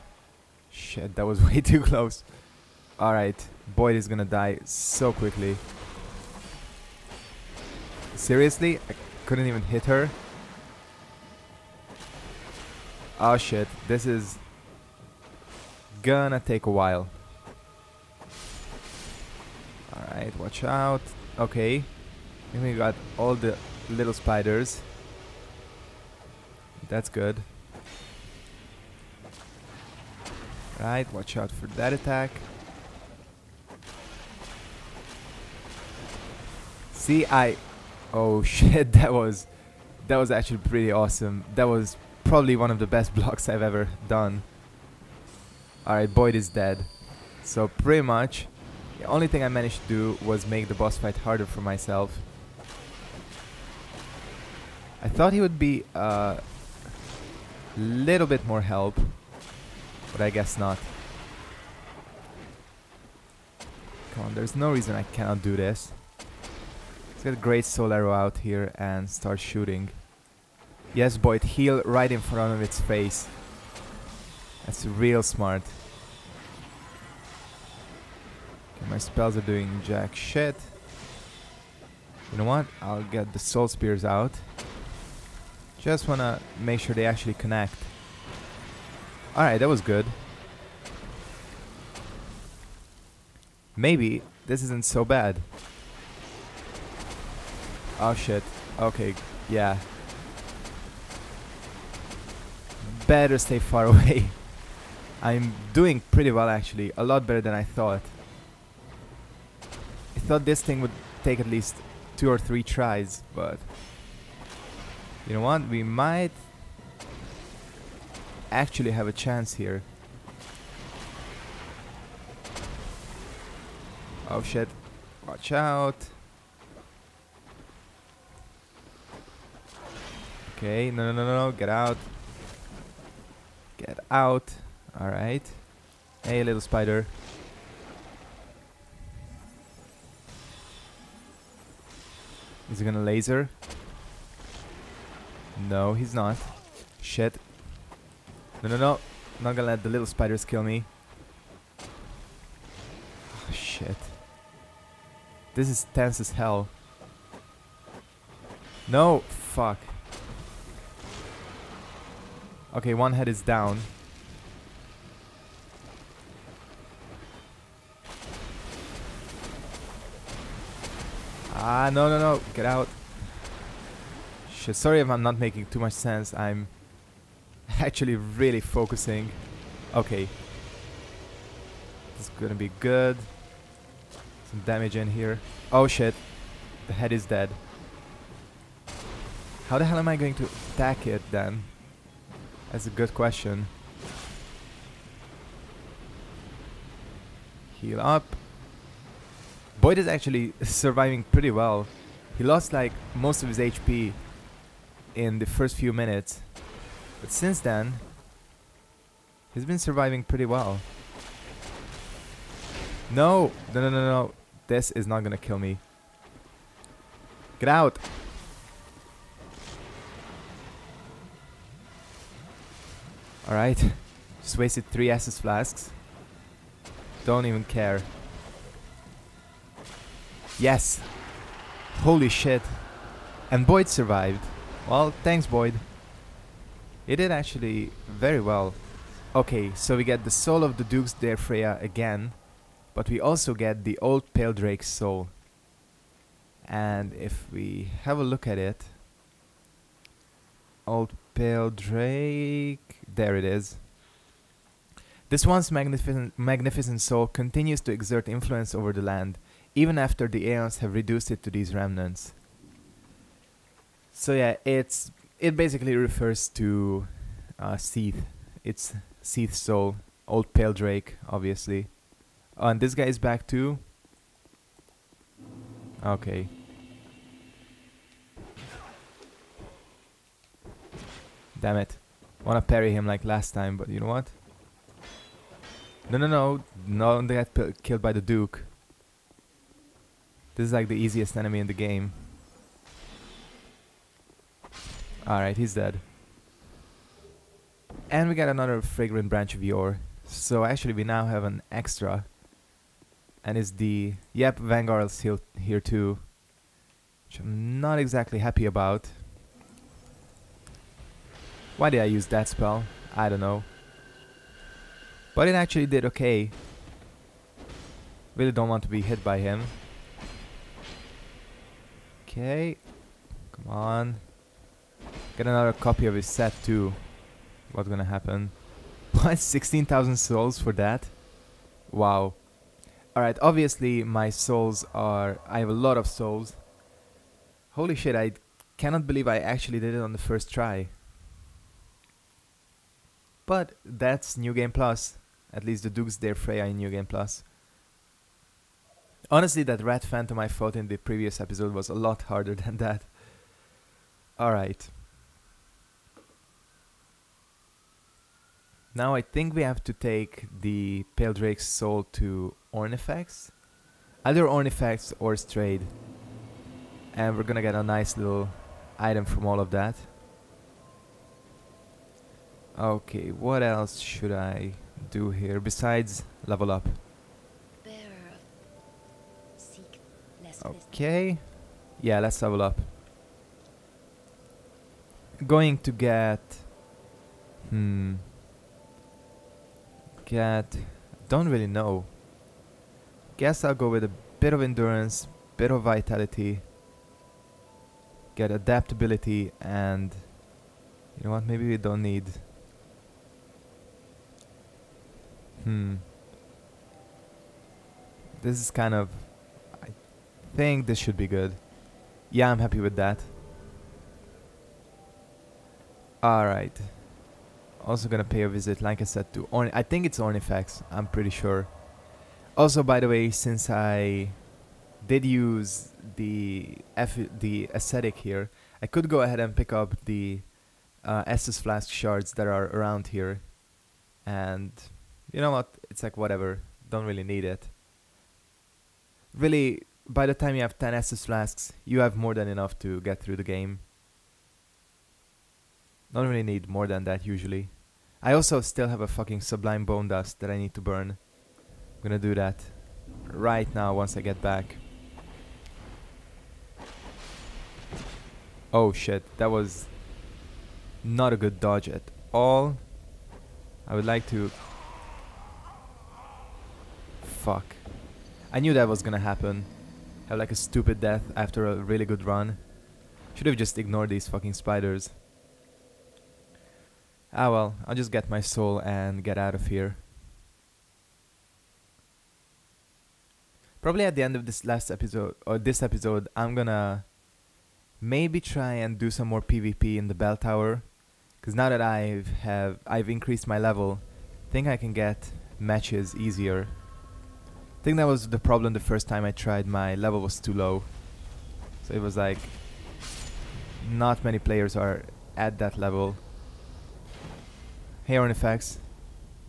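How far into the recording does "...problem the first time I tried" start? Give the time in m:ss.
8:18.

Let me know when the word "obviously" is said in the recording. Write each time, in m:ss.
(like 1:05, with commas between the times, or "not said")
4:31, 5:33.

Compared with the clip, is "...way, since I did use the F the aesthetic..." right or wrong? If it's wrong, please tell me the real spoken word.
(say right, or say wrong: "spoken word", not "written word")
right.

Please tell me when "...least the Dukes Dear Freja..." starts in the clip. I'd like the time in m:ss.
5:45.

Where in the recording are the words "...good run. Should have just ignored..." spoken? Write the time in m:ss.
7:52.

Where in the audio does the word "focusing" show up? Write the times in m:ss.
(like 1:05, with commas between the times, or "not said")
2:58.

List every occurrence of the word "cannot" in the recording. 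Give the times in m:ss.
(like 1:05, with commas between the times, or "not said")
1:05, 5:38.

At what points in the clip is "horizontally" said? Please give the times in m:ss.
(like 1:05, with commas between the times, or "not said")
not said.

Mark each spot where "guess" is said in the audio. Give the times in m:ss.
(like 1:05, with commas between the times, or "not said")
1:00, 6:33.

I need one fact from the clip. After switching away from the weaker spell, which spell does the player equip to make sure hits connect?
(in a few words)
Soul Spears.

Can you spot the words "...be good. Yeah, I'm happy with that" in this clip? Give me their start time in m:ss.
6:51.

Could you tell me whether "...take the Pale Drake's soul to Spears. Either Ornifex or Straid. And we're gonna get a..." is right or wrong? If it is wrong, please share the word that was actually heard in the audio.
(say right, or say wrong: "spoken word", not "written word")
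wrong: "Ornifex", not "Spears".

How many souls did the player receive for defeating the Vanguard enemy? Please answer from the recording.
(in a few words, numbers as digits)
16,000.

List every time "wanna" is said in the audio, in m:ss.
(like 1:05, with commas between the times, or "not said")
1:26, 4:42.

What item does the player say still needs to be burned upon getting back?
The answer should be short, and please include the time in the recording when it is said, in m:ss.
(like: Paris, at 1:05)
Sublime Bone Dust, at 7:29.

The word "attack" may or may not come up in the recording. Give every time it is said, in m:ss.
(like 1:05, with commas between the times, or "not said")
0:31, 3:10.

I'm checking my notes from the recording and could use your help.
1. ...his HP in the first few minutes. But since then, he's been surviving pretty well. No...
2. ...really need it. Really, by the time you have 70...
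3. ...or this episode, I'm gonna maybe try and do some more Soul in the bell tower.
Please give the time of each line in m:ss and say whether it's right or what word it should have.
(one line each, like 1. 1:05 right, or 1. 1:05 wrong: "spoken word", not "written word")
1. 3:23 right
2. 7:17 wrong: "10", not "70"
3. 8:05 wrong: "PvP", not "Soul".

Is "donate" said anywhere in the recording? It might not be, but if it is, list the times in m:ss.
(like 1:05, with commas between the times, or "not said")
not said.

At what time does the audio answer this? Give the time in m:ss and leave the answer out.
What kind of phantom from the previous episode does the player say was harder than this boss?
5:49.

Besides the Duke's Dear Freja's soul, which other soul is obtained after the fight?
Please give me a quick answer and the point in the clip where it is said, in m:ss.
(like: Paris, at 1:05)
Old Pale Drake's soul, at 4:03.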